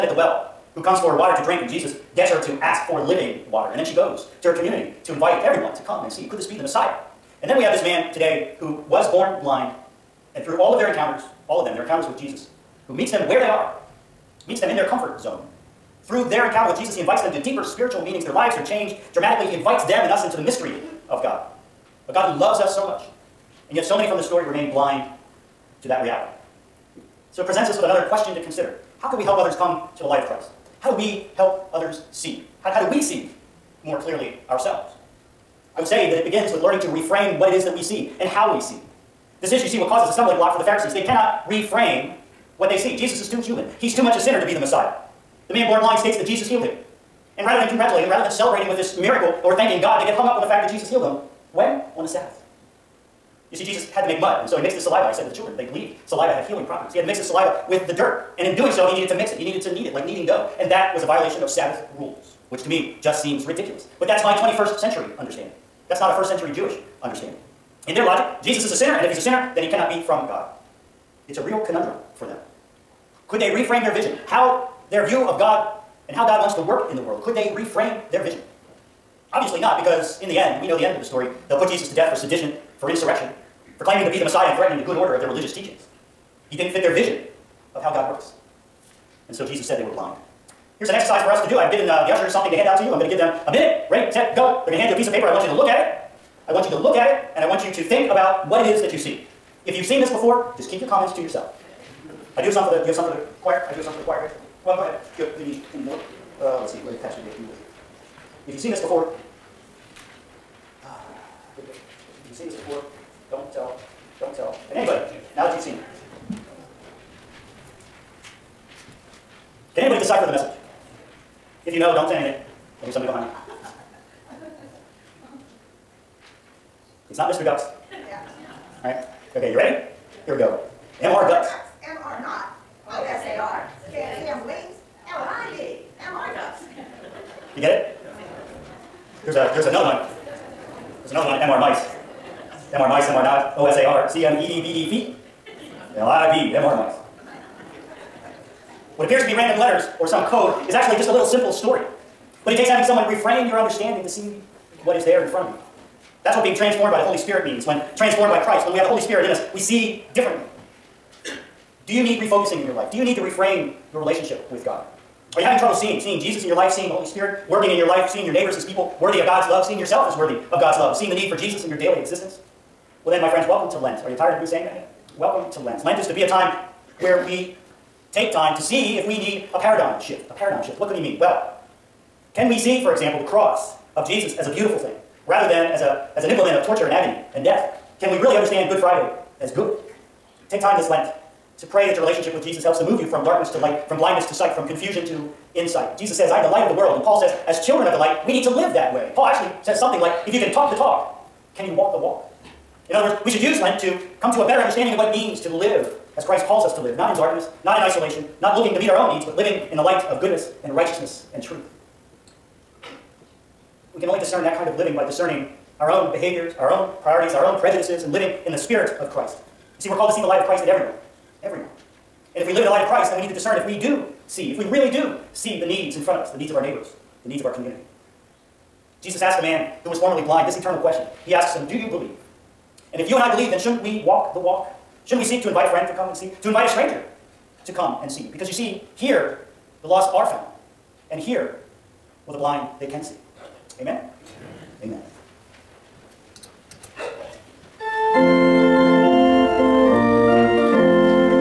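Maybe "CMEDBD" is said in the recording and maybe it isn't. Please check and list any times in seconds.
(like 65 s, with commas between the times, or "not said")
144 s.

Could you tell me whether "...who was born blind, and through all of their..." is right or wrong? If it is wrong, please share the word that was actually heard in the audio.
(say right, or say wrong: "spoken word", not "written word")
right.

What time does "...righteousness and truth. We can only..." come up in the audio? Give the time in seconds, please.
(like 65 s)
210 s.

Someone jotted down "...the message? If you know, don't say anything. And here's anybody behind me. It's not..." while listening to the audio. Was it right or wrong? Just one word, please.
wrong.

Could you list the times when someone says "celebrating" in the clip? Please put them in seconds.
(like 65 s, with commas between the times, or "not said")
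48 s.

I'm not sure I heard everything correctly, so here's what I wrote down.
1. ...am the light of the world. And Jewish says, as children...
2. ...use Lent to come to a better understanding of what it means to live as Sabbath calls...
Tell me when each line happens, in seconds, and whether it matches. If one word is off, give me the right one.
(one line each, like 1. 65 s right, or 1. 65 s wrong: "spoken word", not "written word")
1. 196 s wrong: "Paul", not "Jewish"
2. 203 s wrong: "Christ", not "Sabbath".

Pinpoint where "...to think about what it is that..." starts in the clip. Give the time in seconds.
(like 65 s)
97 s.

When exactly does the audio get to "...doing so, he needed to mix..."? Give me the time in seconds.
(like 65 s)
58 s.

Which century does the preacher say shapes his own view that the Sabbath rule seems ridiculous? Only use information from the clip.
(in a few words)
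21st century.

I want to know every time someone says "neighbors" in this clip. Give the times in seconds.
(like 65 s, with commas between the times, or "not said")
168 s, 226 s.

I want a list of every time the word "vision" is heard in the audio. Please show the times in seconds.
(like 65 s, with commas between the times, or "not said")
73 s, 78 s, 86 s.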